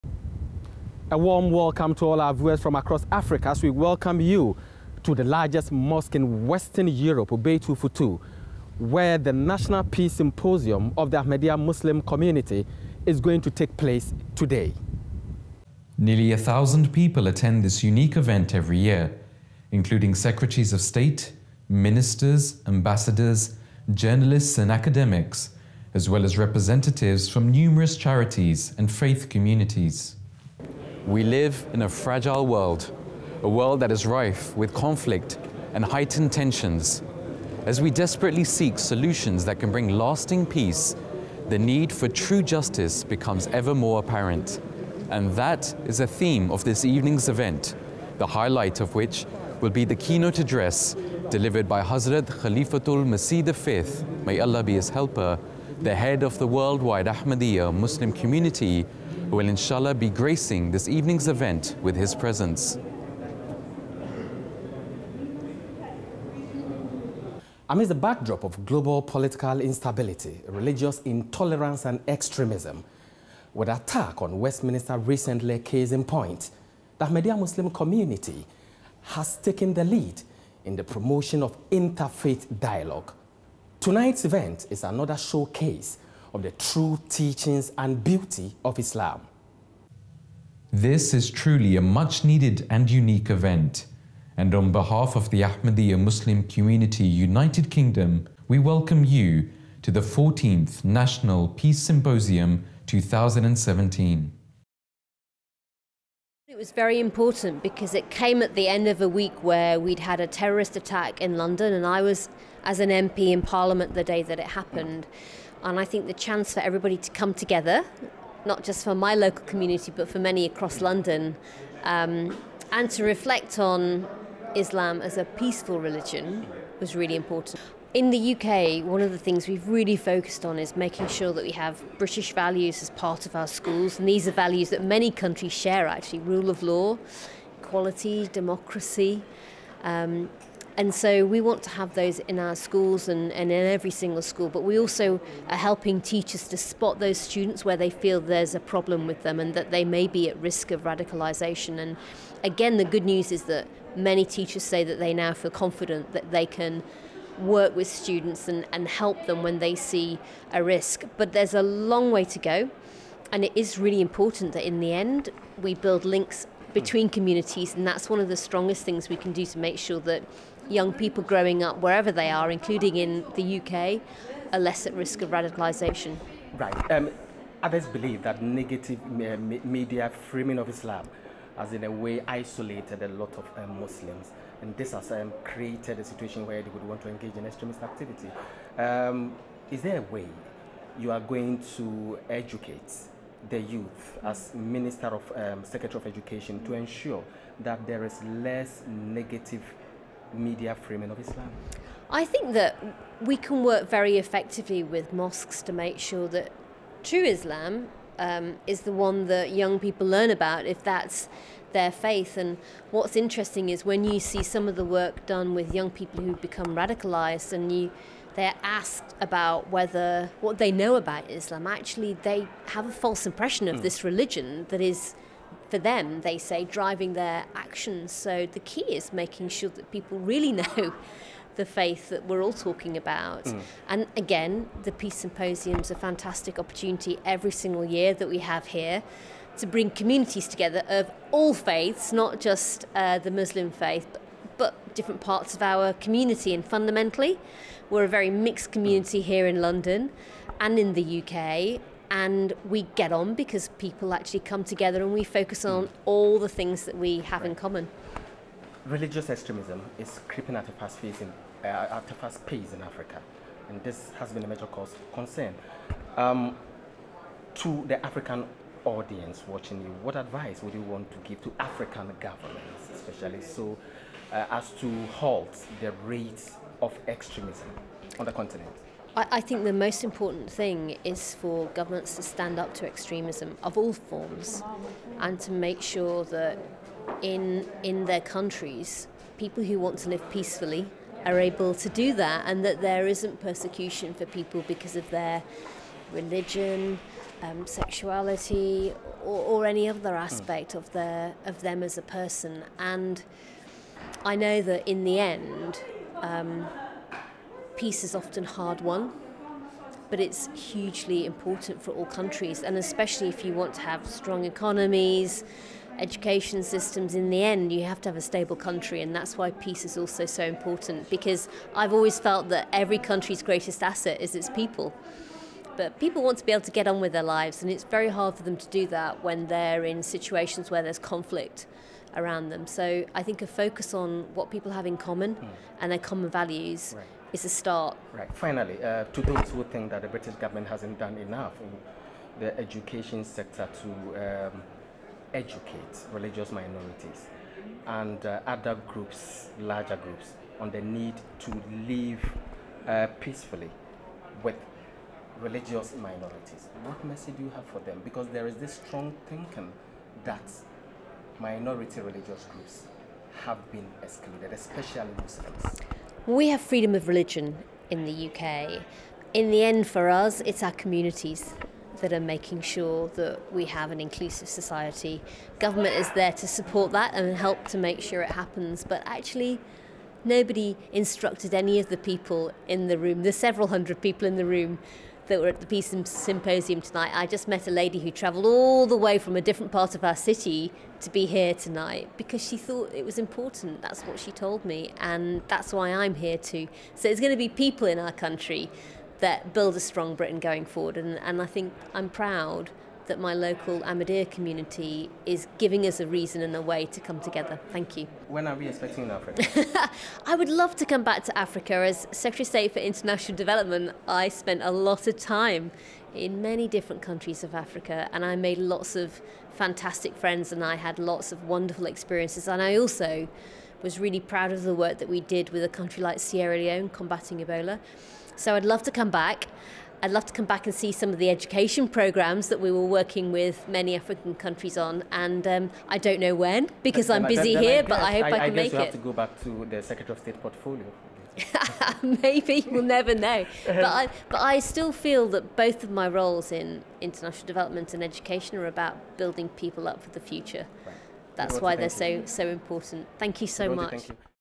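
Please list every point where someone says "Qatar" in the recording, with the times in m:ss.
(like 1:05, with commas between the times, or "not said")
not said.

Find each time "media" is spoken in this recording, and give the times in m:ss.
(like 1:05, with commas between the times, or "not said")
2:59, 3:20.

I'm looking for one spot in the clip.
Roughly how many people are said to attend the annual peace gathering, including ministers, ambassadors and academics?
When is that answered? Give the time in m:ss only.
0:15.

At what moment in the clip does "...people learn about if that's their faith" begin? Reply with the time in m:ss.
3:29.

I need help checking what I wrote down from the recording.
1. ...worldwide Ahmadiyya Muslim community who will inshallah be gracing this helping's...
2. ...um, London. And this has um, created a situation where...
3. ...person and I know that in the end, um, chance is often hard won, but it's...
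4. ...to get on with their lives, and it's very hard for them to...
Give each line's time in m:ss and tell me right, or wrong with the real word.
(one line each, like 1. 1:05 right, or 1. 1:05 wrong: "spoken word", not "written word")
1. 0:56 wrong: "evening", not "helping"
2. 3:03 wrong: "Muslims", not "London"
3. 5:02 wrong: "peace", not "chance"
4. 5:26 right.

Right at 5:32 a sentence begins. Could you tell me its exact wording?
So I think a focus on what people have in common mm.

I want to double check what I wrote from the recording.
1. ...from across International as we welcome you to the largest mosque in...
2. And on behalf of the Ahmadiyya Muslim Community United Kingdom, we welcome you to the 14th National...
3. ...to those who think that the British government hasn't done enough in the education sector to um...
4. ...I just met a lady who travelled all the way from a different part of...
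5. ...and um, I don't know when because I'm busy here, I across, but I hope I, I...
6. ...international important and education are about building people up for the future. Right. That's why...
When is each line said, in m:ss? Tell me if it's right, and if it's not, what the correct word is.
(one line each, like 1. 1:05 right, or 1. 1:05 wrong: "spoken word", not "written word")
1. 0:02 wrong: "Africa", not "International"
2. 1:34 right
3. 5:39 right
4. 6:27 right
5. 7:15 wrong: "guess", not "across"
6. 7:26 wrong: "development", not "important".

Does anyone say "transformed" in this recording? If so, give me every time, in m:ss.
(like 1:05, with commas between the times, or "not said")
not said.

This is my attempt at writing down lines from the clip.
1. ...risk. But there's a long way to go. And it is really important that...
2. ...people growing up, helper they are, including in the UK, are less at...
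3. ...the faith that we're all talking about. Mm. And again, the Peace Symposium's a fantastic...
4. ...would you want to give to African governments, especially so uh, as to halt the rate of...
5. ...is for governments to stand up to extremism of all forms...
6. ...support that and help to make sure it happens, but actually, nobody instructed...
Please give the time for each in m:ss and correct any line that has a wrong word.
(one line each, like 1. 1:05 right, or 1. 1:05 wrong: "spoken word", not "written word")
1. 2:40 right
2. 2:50 wrong: "wherever", not "helper"
3. 3:51 right
4. 4:30 right
5. 4:41 right
6. 6:16 right.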